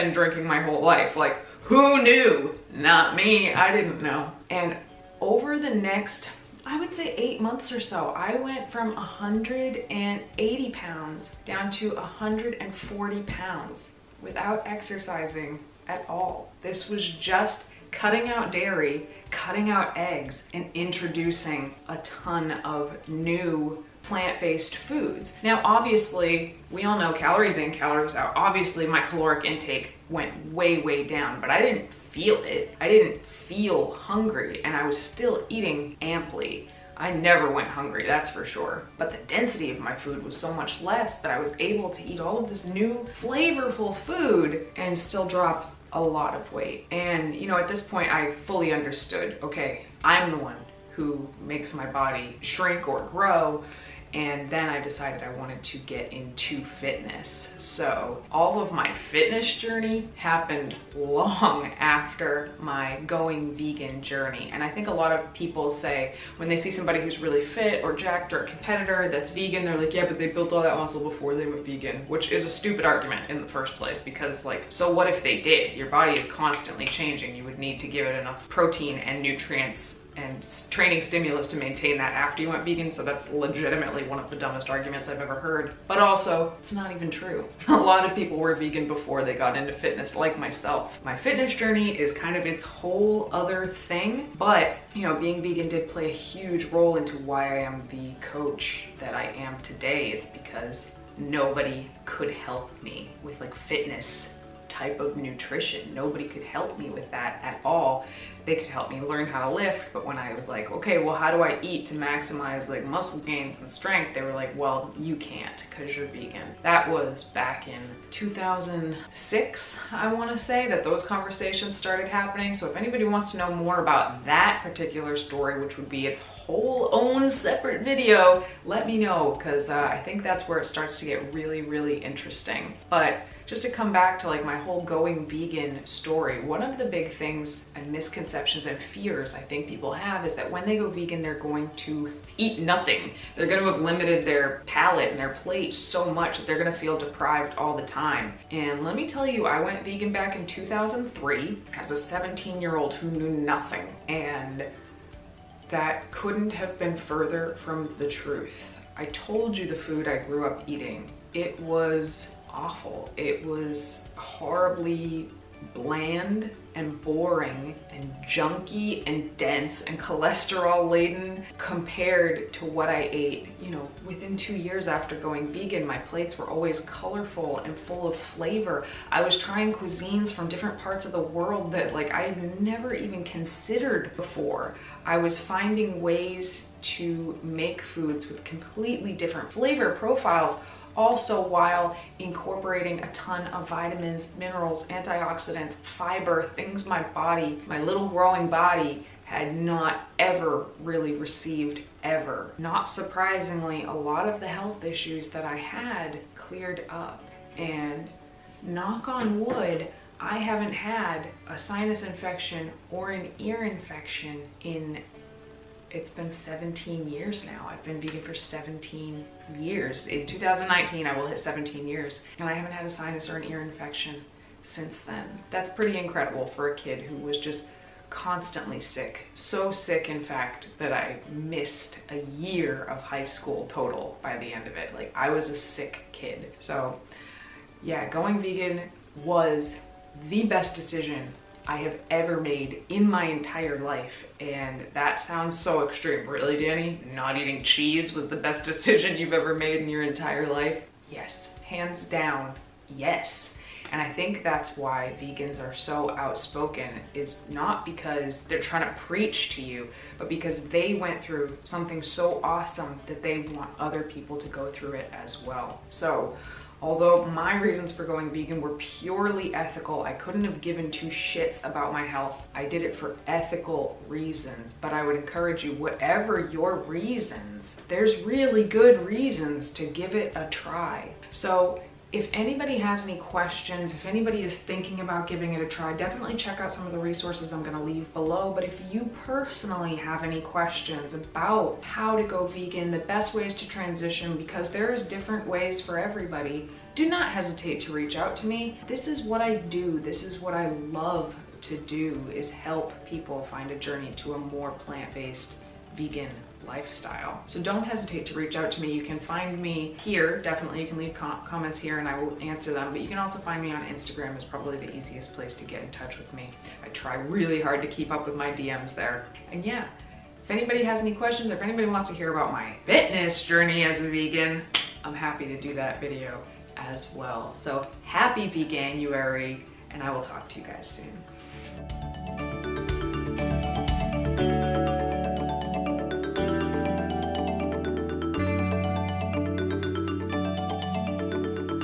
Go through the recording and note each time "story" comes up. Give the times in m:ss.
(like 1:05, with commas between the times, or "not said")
2:05, 2:15.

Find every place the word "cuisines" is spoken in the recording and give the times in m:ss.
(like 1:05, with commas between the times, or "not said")
2:59.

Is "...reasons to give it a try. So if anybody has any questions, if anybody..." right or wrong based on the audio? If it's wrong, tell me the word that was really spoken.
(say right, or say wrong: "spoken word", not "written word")
right.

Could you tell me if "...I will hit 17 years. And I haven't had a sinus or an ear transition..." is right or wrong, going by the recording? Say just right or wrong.
wrong.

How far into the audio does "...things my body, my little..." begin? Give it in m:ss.
3:16.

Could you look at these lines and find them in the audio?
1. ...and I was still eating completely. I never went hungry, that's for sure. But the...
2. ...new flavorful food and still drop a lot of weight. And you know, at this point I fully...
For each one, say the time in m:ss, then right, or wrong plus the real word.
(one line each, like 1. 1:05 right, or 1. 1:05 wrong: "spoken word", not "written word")
1. 0:34 wrong: "amply", not "completely"
2. 0:42 right.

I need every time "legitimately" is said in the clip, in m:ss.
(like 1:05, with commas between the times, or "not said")
1:23.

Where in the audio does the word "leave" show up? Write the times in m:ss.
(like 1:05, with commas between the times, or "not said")
4:47, 5:10.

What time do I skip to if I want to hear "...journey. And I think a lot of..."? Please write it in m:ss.
1:04.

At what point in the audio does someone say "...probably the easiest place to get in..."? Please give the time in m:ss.
5:14.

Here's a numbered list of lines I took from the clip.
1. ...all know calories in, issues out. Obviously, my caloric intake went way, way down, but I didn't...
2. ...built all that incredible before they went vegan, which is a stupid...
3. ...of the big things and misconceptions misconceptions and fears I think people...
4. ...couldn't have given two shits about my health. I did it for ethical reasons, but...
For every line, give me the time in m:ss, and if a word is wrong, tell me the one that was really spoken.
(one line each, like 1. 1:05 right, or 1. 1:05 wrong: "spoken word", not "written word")
1. 0:26 wrong: "calories", not "issues"
2. 1:10 wrong: "muscle", not "incredible"
3. 2:16 right
4. 4:30 right.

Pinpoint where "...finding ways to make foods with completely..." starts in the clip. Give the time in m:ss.
3:05.